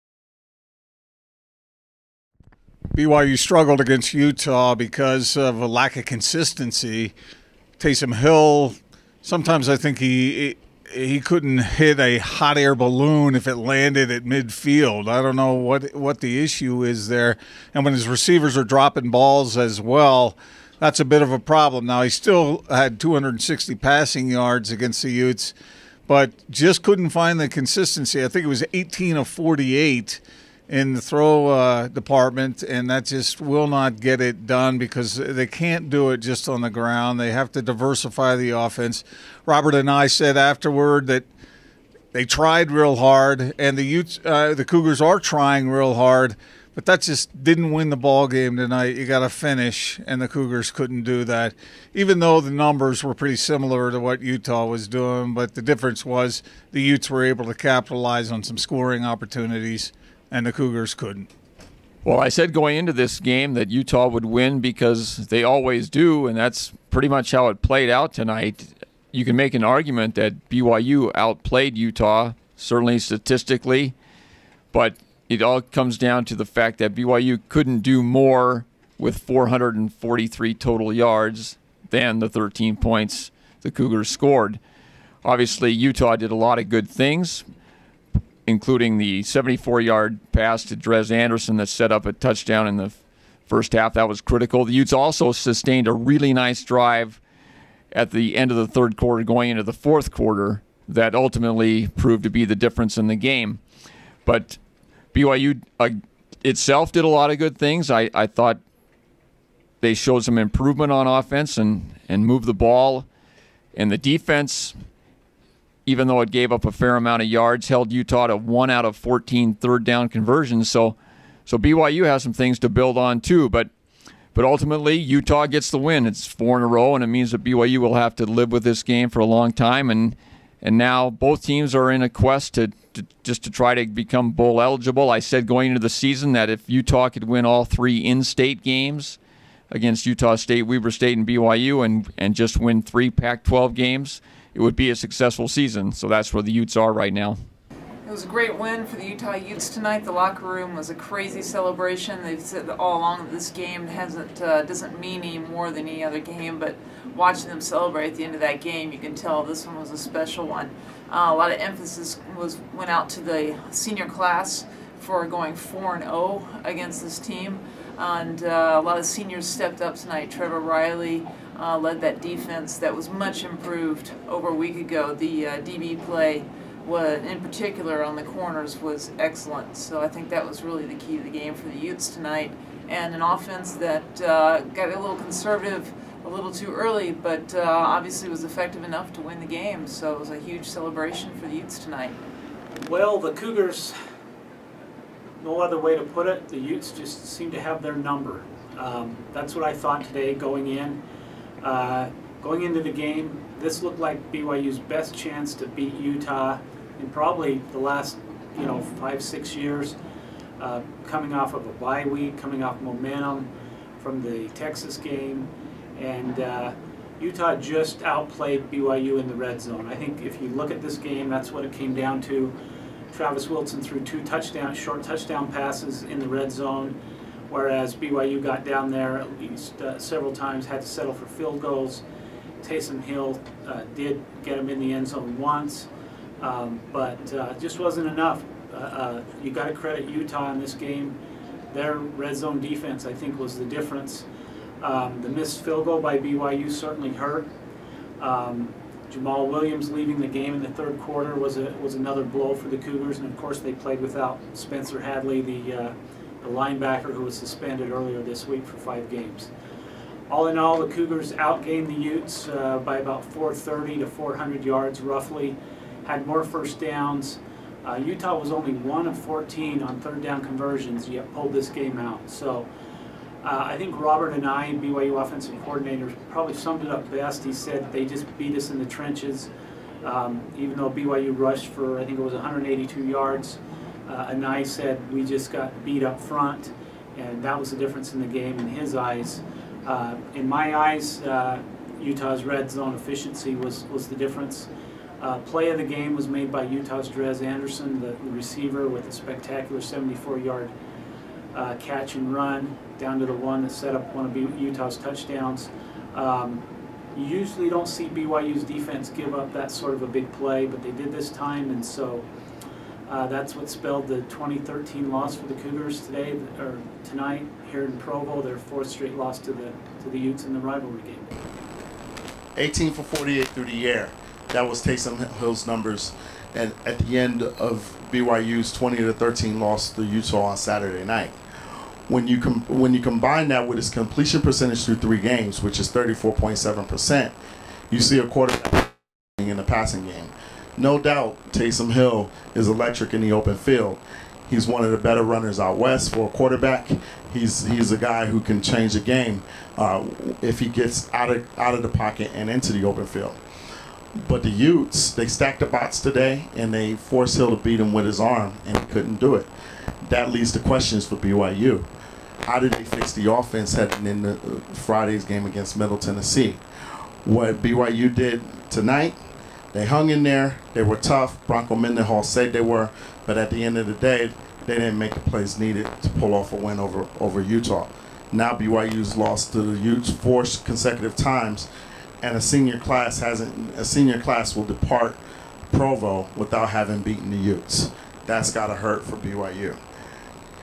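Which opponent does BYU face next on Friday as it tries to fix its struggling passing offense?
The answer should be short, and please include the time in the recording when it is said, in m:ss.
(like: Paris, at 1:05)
Middle Tennessee, at 6:05.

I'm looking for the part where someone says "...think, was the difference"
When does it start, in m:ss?
4:03.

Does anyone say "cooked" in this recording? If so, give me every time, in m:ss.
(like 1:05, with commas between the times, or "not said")
not said.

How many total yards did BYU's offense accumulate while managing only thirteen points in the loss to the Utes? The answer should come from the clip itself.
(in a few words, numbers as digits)
443.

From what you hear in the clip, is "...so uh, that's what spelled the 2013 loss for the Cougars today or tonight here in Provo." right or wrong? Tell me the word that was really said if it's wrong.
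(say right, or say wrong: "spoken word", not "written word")
right.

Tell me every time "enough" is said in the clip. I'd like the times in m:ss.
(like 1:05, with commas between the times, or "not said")
3:08, 3:58.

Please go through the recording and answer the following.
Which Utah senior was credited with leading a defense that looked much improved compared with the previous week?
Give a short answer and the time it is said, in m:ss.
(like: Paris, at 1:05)
Trevor Reilly, at 2:50.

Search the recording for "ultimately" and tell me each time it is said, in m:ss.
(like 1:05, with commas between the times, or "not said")
1:41, 2:04.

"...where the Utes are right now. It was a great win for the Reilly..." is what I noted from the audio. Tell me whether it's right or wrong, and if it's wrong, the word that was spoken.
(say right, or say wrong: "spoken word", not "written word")
wrong: "Utah", not "Reilly".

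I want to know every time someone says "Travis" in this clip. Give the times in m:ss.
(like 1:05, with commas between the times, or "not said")
3:43.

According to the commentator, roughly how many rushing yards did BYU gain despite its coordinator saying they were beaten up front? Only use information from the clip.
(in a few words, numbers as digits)
182.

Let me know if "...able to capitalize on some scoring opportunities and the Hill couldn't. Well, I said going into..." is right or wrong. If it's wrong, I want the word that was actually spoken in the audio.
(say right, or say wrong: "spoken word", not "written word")
wrong: "Cougars", not "Hill".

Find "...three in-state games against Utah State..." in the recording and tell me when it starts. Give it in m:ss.
2:17.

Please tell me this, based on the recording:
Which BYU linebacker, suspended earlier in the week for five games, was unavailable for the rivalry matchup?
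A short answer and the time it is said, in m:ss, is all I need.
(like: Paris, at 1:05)
Spencer Hadley, at 4:14.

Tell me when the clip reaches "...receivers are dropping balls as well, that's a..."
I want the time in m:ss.
0:18.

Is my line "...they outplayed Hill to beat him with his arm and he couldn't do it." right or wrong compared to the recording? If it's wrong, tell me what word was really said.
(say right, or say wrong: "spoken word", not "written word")
wrong: "forced", not "outplayed".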